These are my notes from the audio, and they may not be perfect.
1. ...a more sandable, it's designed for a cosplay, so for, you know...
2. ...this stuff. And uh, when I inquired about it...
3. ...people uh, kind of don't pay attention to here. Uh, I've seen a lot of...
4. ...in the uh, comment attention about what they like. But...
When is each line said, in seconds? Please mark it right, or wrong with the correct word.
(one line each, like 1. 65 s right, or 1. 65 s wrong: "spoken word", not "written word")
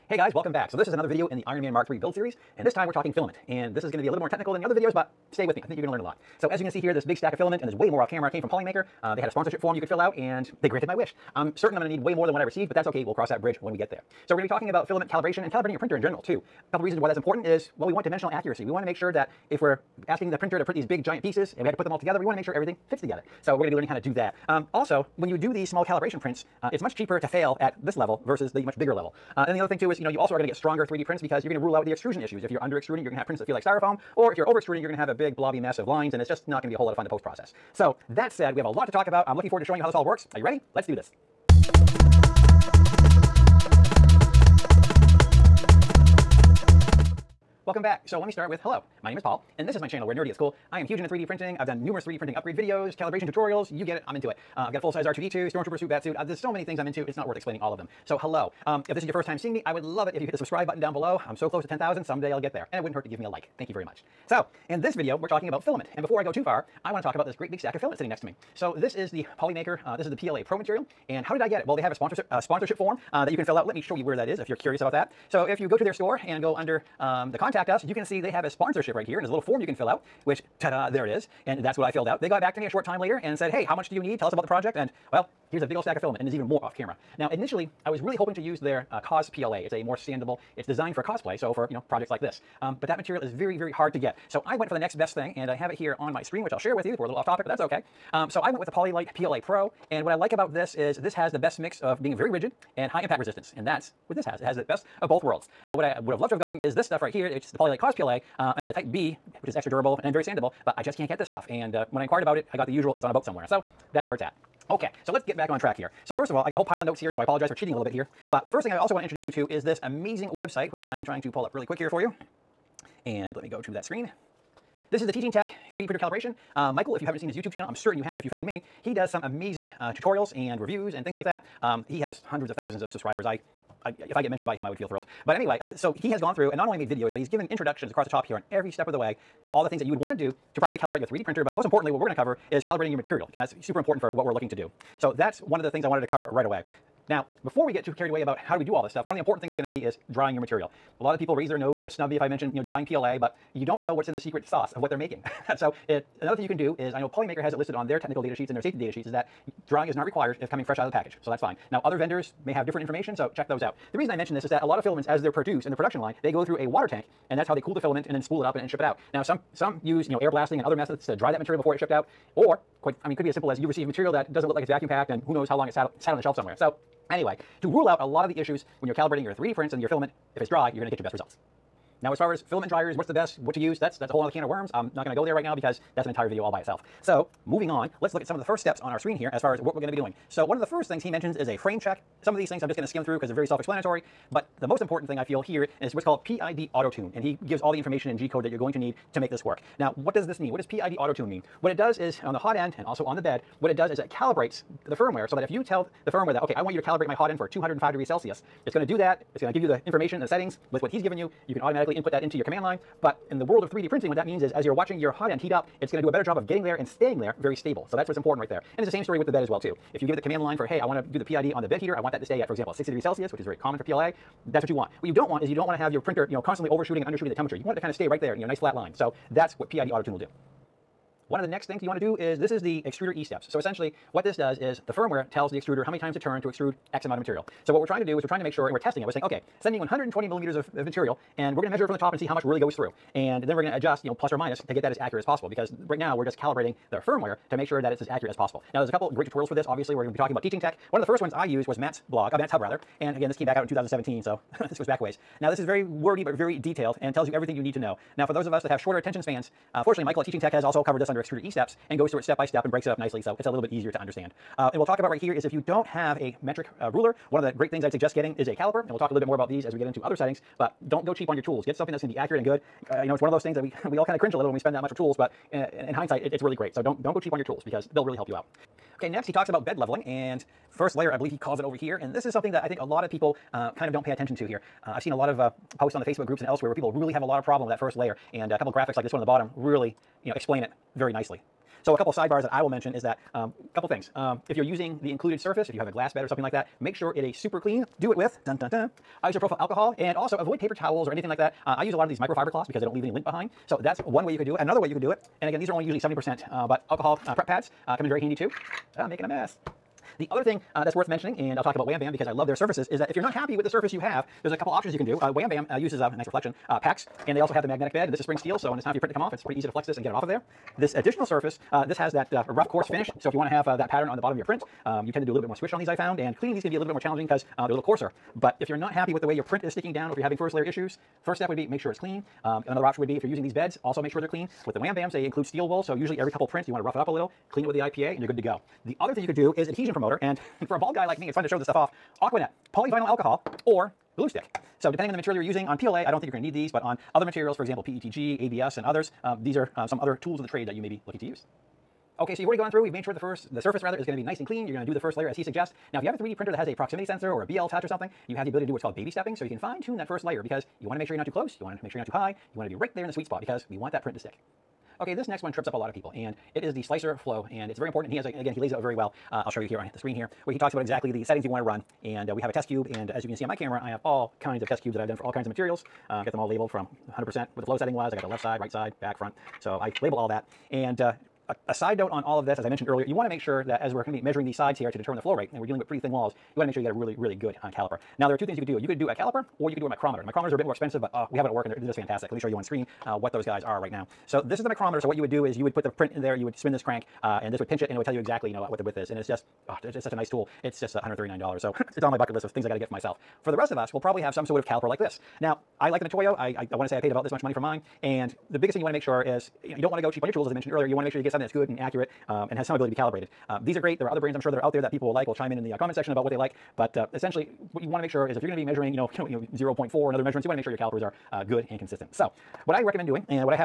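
1. 89 s right
2. 111 s right
3. 283 s right
4. 415 s wrong: "section", not "attention".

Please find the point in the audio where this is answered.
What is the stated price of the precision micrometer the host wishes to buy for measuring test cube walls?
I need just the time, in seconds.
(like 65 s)
400 s.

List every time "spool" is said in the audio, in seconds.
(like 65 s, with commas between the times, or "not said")
168 s.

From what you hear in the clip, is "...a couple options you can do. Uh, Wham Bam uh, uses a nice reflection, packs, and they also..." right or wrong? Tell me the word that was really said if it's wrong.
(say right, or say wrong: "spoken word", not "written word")
right.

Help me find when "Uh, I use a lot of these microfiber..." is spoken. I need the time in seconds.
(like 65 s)
301 s.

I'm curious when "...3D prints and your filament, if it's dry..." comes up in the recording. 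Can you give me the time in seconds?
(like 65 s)
179 s.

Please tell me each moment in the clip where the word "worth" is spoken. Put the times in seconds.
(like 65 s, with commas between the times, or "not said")
57 s, 310 s.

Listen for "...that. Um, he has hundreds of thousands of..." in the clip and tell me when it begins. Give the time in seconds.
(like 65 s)
131 s.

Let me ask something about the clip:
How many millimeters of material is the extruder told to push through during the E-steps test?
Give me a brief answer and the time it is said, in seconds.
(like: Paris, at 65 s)
120, at 239 s.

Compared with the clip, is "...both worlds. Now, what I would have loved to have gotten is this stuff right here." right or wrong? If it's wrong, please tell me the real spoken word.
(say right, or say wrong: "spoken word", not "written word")
right.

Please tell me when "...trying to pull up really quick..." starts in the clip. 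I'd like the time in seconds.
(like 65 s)
121 s.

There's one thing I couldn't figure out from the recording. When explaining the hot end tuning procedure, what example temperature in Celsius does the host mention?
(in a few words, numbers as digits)
205.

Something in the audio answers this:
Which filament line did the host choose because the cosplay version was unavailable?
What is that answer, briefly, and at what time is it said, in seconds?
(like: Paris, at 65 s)
Polylite PLA Pro, at 98 s.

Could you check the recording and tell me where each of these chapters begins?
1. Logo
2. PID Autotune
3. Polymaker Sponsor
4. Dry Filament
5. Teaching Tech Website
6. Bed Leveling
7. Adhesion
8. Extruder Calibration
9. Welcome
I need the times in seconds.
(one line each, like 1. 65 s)
1. 41 s
2. 188 s
3. 66 s
4. 149 s
5. 114 s
6. 279 s
7. 295 s
8. 230 s
9. 47 s.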